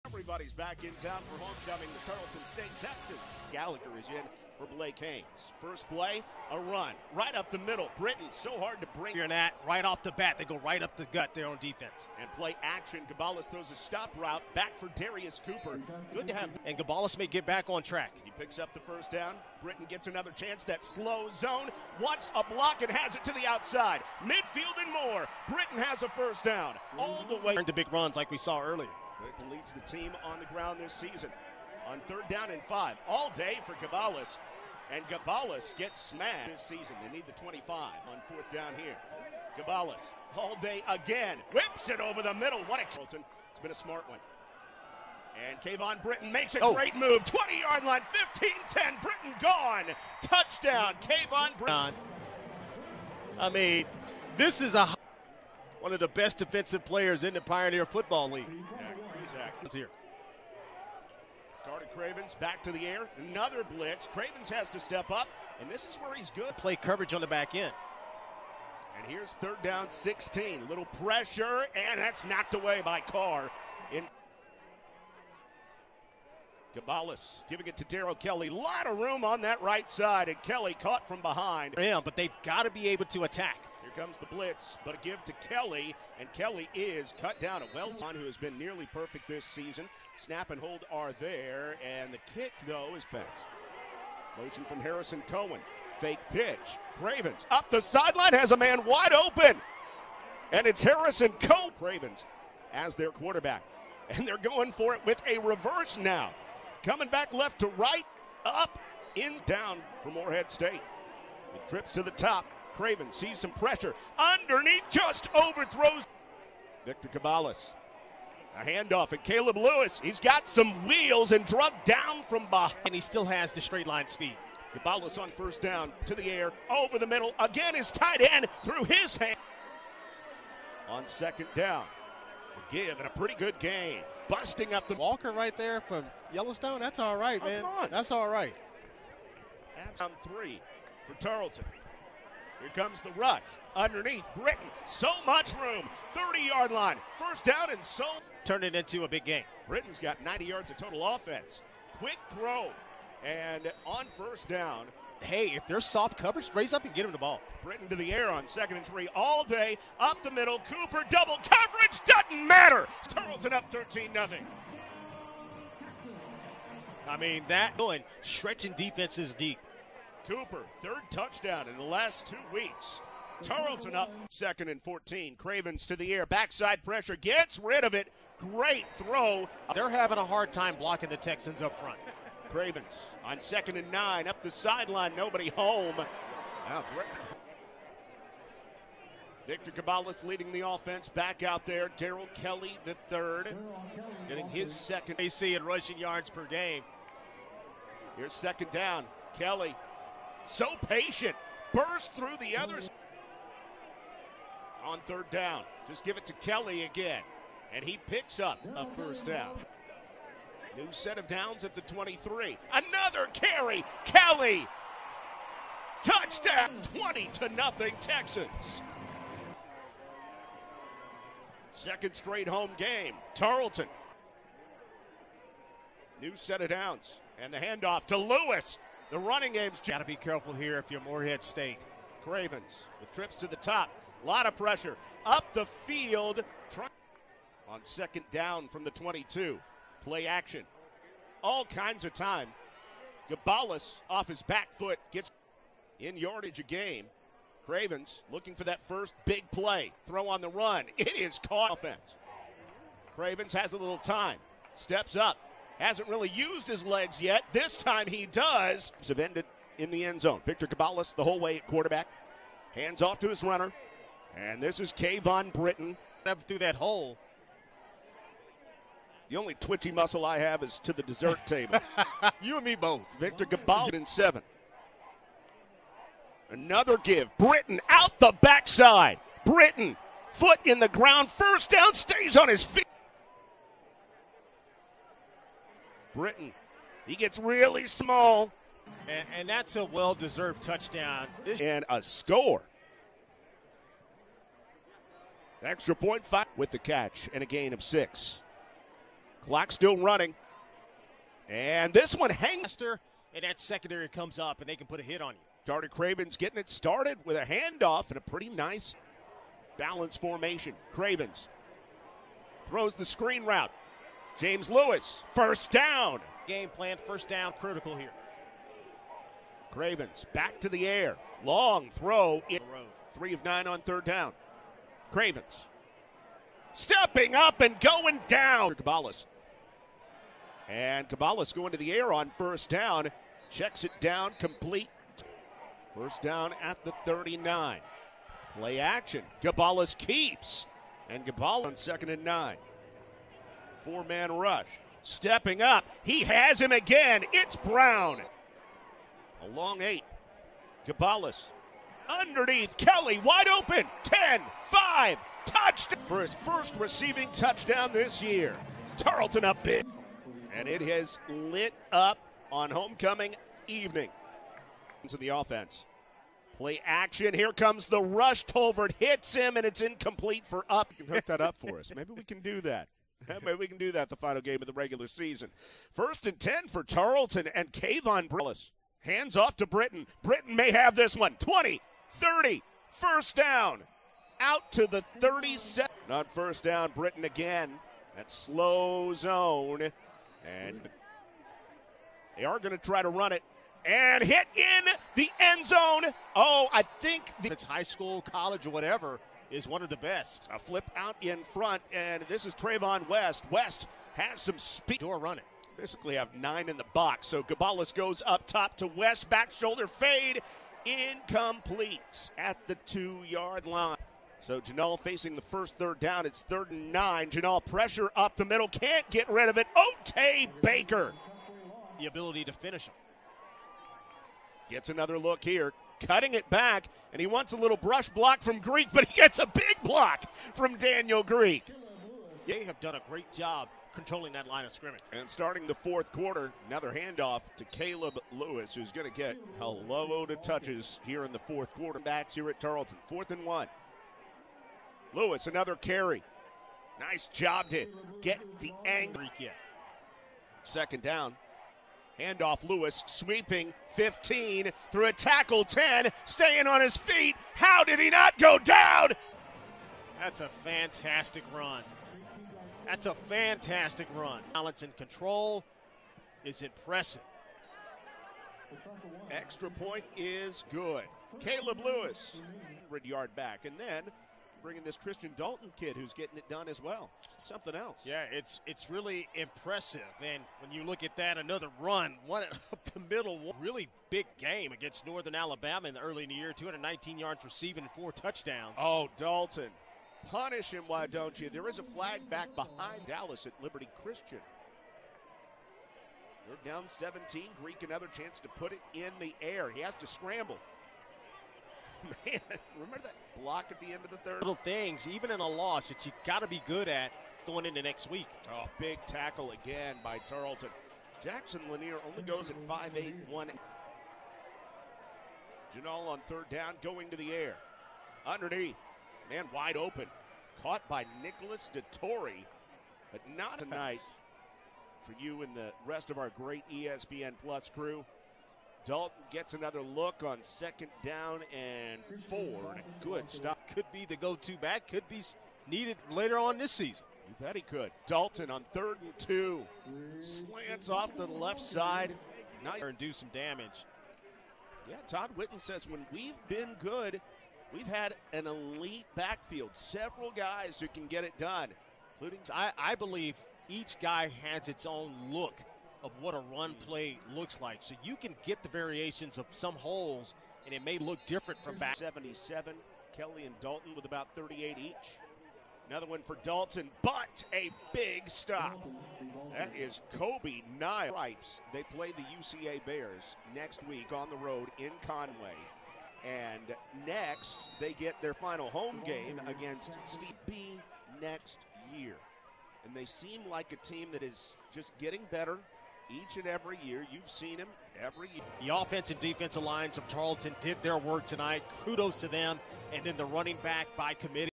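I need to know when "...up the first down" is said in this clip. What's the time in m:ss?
0:18.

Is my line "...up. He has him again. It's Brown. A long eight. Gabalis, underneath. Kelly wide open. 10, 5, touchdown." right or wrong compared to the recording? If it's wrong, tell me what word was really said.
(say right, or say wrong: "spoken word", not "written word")
right.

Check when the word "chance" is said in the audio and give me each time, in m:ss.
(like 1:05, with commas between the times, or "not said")
0:20, 8:18.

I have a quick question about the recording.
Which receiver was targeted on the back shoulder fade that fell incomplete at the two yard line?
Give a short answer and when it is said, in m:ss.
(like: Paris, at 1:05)
Trayvon West, at 6:42.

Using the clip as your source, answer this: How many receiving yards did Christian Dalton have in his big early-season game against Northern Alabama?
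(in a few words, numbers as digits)
219.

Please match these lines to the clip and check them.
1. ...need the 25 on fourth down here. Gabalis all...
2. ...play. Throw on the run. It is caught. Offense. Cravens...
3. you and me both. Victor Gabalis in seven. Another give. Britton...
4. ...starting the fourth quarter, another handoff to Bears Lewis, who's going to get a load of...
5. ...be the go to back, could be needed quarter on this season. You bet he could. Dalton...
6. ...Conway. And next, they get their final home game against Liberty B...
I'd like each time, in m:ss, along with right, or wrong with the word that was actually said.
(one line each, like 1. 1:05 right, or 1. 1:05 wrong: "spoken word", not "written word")
1. 0:37 right
2. 4:09 right
3. 4:32 right
4. 7:15 wrong: "Caleb", not "Bears"
5. 8:53 wrong: "later", not "quarter"
6. 9:35 wrong: "Steve", not "Liberty".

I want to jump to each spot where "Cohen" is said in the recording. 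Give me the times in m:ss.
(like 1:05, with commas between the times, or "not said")
1:35, 1:41.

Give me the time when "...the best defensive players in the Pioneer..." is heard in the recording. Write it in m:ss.
0:55.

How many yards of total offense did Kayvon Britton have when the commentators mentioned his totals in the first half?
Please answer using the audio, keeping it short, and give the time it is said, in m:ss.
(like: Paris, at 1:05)
90, at 2:30.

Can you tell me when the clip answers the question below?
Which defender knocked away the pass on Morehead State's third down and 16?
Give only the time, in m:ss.
1:13.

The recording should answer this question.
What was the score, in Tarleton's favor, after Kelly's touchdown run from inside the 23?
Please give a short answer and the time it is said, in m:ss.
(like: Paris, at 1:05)
20-0, at 3:36.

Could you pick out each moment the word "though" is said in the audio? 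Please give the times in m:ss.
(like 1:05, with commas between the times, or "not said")
1:32.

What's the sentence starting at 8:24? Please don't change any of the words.
Little things, even in a loss, that you got to be good at going into next week.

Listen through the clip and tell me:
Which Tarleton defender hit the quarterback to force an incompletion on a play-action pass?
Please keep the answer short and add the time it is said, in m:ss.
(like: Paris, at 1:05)
Tolbert, at 6:08.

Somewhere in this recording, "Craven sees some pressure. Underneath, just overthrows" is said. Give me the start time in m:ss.
1:52.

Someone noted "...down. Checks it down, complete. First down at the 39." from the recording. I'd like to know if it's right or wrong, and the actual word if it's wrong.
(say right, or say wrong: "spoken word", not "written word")
right.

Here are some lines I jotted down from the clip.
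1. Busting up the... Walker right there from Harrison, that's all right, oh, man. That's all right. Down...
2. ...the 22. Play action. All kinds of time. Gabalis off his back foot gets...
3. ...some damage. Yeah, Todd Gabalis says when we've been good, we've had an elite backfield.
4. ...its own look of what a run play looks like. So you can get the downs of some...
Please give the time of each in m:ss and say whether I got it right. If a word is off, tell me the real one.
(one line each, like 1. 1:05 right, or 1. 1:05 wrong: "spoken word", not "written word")
1. 2:14 wrong: "Yellowstone", not "Harrison"
2. 3:58 right
3. 9:03 wrong: "Whitten", not "Gabalis"
4. 9:14 wrong: "variations", not "downs".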